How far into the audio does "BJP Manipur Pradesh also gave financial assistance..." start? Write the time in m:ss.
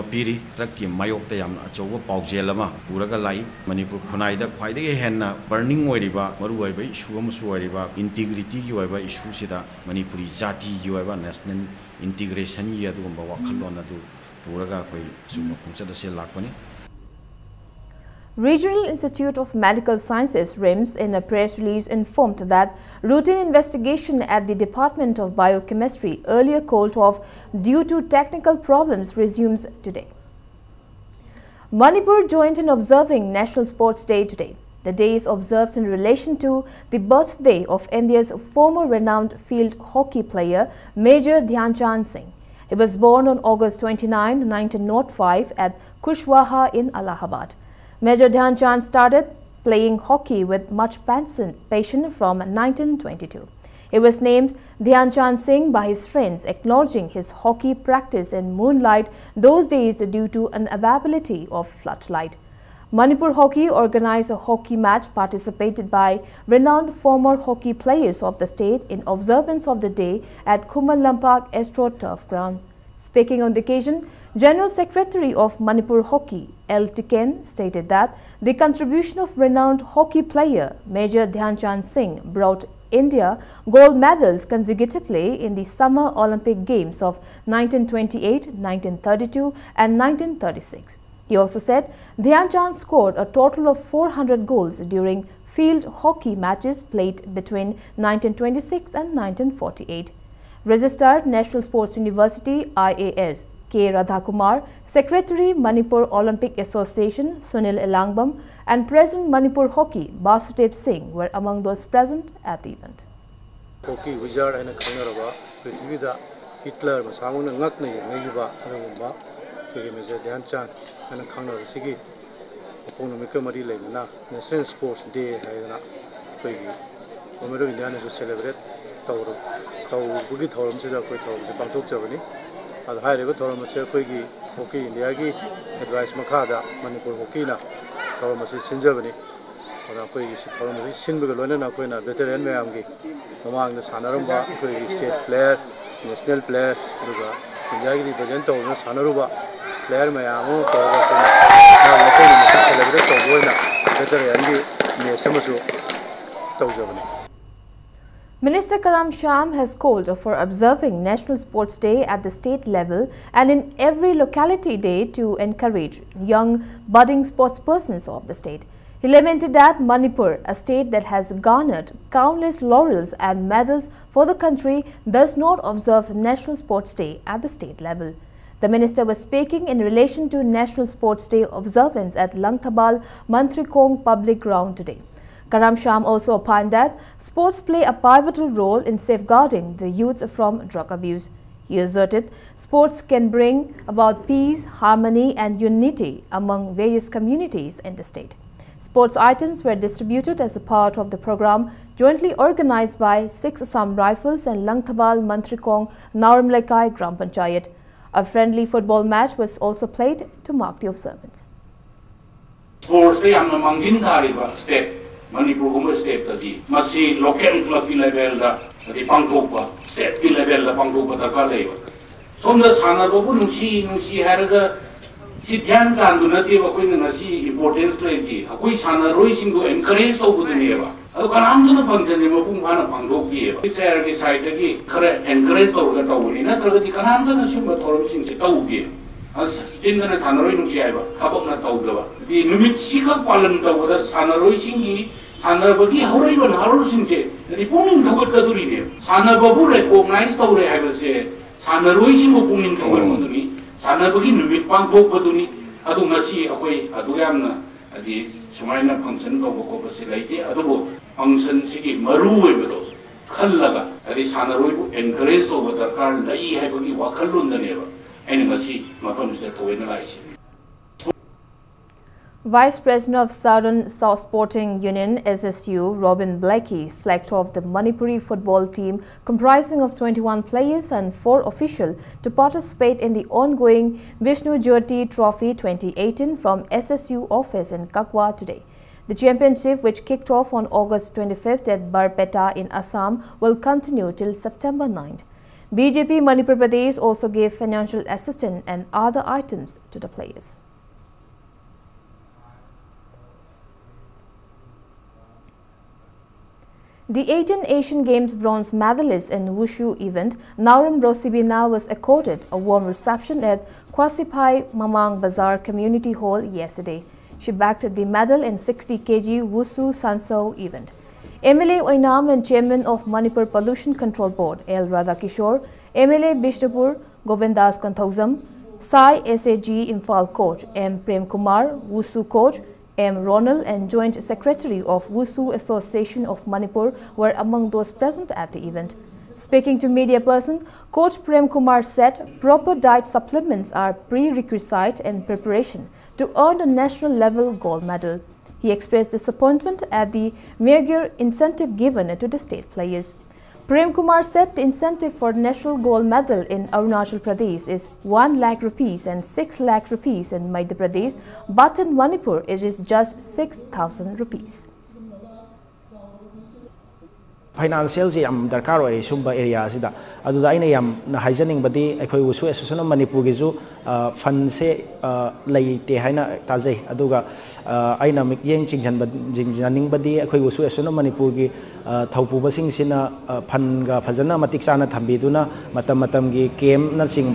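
4:55.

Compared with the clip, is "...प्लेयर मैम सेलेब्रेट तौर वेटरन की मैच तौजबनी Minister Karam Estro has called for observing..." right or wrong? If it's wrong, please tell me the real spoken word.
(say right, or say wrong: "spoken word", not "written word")
wrong: "Shyam", not "Estro".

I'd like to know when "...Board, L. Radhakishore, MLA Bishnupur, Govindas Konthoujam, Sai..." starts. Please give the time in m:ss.
5:24.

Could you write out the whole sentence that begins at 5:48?
He expressed disappointment at the meager incentive given to the state players.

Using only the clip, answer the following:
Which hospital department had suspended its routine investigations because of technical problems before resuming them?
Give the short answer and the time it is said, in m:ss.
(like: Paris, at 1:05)
Department of Biochemistry, at 0:24.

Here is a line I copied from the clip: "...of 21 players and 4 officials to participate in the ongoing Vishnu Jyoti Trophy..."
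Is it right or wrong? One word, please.
right.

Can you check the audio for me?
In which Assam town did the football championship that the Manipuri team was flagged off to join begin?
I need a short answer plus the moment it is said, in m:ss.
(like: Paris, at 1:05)
Barpeta, at 4:51.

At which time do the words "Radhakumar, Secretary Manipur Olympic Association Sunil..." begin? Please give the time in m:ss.
1:43.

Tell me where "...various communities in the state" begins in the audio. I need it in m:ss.
3:16.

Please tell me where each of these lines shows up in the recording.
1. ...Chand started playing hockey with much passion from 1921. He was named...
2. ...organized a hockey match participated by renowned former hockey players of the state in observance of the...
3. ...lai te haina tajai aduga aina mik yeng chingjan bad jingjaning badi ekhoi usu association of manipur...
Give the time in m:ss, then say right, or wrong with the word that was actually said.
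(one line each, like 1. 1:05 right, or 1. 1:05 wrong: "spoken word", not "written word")
1. 0:48 wrong: "1922", not "1921"
2. 1:03 right
3. 6:15 right.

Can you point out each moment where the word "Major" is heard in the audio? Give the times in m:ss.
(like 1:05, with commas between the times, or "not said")
0:40, 0:47, 1:20, 1:59.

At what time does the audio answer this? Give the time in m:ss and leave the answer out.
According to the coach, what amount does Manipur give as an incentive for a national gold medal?
6:03.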